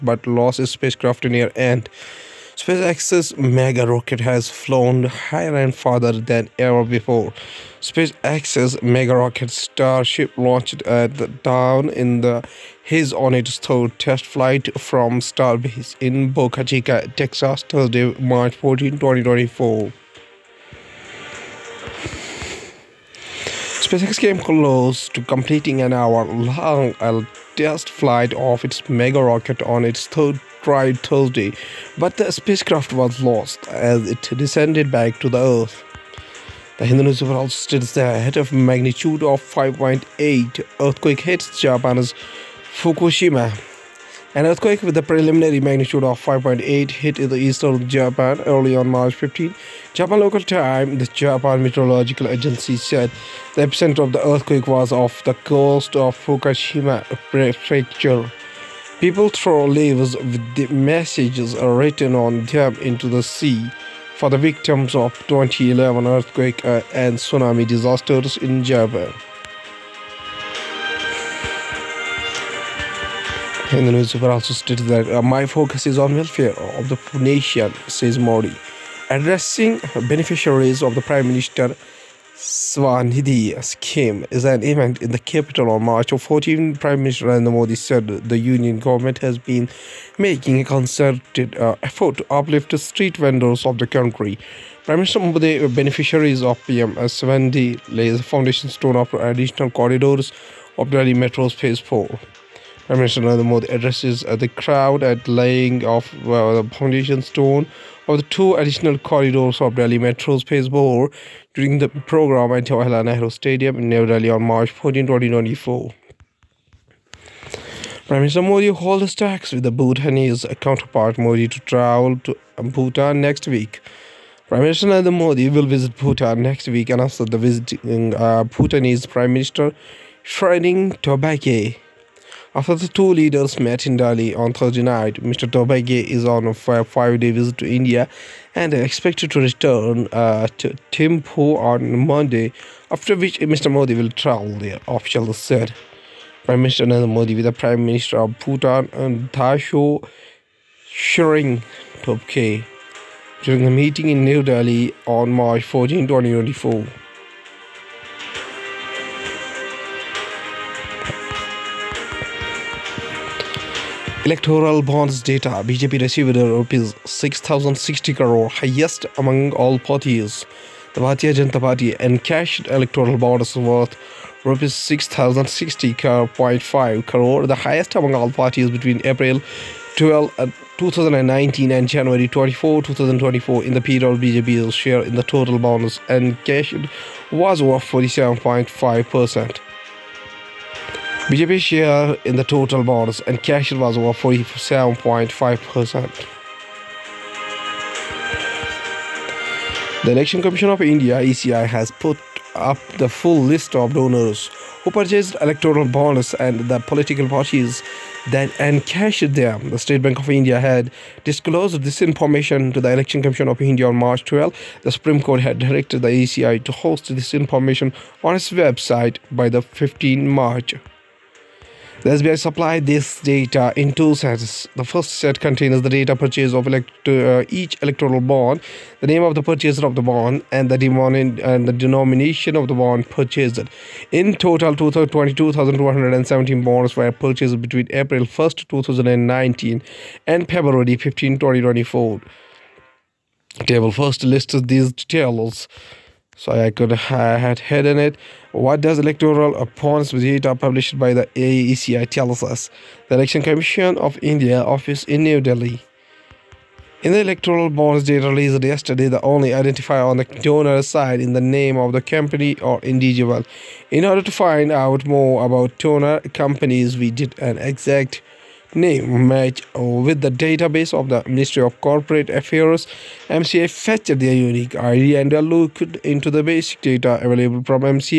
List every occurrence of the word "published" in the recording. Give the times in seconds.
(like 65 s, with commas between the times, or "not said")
250 s.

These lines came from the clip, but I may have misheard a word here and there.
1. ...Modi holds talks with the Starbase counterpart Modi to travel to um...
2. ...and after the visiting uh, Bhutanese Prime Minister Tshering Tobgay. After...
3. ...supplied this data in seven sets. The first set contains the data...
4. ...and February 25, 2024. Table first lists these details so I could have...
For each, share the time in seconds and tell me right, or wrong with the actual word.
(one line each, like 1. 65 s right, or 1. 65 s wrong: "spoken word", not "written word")
1. 118 s wrong: "Bhutanese", not "Starbase"
2. 126 s right
3. 222 s wrong: "two", not "seven"
4. 240 s wrong: "15", not "25".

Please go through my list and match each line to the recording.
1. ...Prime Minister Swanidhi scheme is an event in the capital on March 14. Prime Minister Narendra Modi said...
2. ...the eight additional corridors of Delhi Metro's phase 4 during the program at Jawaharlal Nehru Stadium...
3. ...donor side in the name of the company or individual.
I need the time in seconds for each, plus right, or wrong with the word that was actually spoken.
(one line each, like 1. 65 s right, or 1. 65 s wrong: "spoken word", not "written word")
1. 80 s right
2. 108 s wrong: "two", not "eight"
3. 260 s right.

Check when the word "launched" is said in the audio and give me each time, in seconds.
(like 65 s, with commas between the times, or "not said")
10 s.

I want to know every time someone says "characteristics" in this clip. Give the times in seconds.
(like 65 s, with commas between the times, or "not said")
not said.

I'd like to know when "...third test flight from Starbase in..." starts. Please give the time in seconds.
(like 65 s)
13 s.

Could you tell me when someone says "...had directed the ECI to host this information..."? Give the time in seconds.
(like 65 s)
215 s.